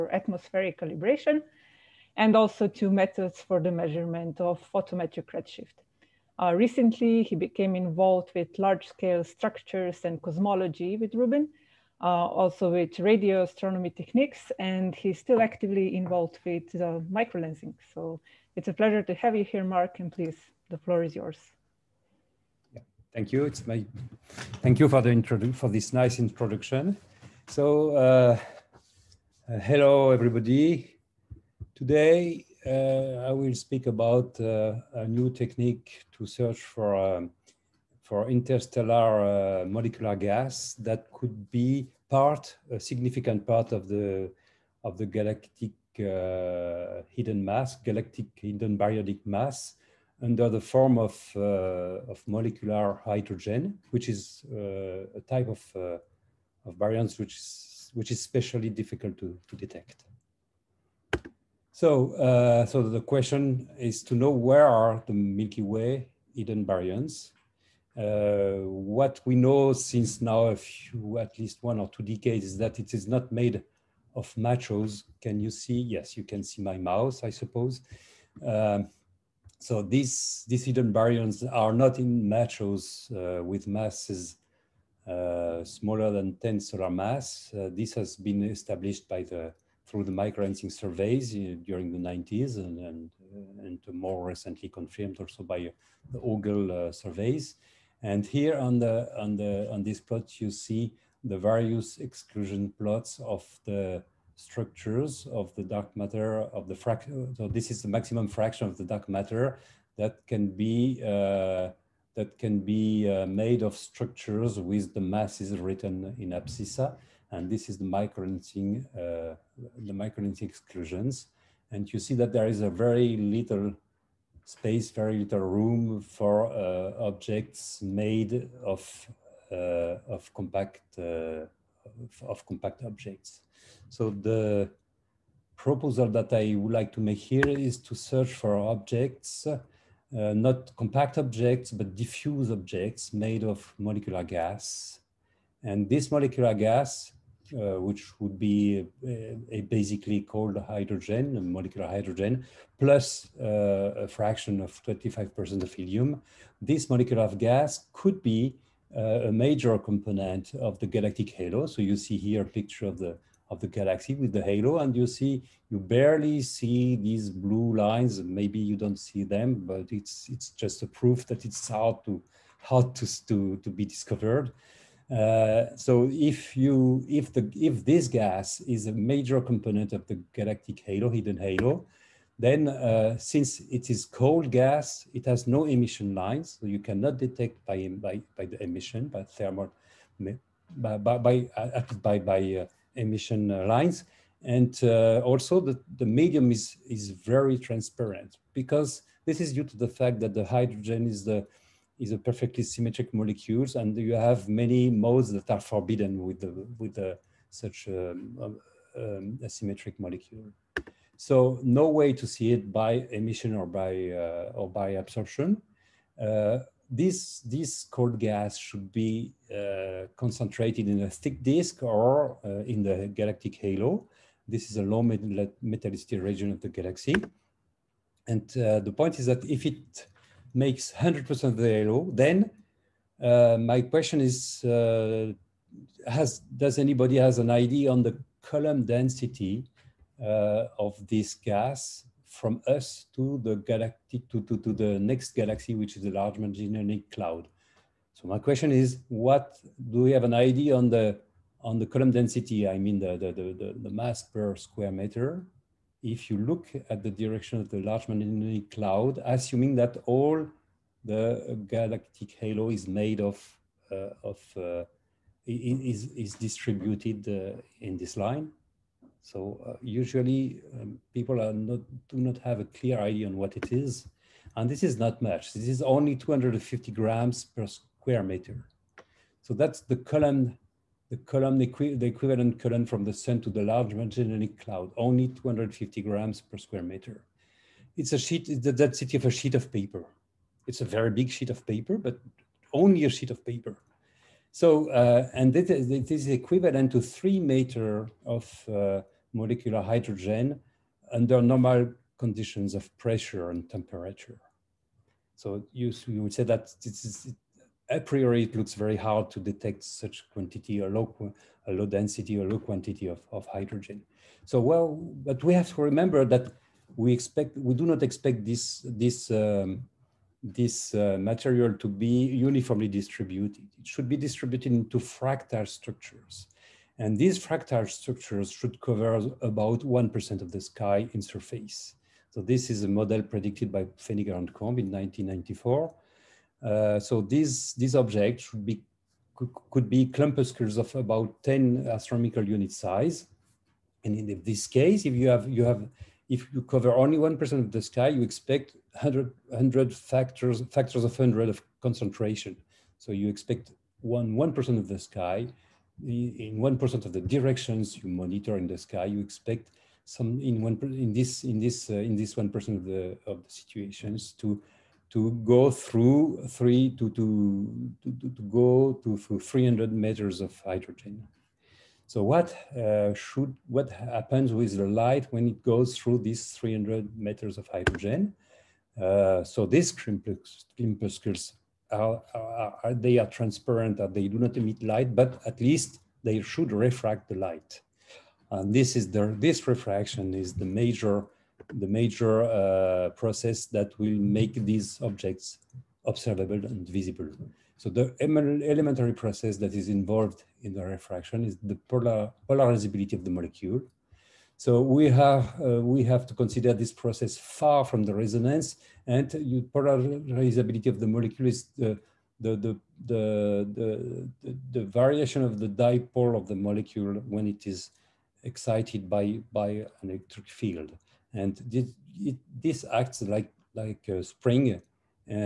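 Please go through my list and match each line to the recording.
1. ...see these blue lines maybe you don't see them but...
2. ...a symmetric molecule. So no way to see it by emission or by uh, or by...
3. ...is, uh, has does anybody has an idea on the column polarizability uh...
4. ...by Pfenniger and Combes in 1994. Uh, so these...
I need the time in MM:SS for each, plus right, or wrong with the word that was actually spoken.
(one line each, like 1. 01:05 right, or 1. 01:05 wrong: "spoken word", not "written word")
1. 02:46 right
2. 03:29 right
3. 03:54 wrong: "density", not "polarizability"
4. 05:33 right.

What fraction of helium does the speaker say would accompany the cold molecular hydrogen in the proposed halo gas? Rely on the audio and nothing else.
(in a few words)
25%.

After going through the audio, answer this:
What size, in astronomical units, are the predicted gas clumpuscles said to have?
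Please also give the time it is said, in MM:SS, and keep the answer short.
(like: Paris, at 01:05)
10 AU, at 05:41.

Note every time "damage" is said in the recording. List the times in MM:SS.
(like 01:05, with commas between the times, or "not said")
not said.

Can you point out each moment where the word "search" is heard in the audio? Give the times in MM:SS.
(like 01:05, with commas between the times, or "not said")
00:36, 02:17.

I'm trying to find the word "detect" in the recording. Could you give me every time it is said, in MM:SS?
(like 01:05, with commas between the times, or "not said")
00:59, 03:07, 05:09.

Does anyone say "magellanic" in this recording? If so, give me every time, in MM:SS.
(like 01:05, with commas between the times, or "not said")
04:06, 04:18, 04:43.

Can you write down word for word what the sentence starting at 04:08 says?
So my question is, what do we have an idea on the on the column density?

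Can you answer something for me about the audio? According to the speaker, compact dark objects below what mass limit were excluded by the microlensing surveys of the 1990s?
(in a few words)
10 solar masses.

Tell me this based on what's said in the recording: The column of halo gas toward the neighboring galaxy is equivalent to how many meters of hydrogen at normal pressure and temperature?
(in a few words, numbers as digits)
3 meters.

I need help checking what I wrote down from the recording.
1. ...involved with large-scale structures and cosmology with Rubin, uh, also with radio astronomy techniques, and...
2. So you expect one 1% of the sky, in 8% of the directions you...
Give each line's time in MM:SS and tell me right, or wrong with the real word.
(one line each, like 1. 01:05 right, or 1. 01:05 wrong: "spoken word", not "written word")
1. 00:07 right
2. 05:52 wrong: "1", not "8".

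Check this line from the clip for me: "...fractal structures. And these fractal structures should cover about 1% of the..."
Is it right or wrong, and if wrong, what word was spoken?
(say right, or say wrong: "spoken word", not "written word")
right.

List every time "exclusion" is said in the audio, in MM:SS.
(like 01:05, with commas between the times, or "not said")
01:41, 02:00.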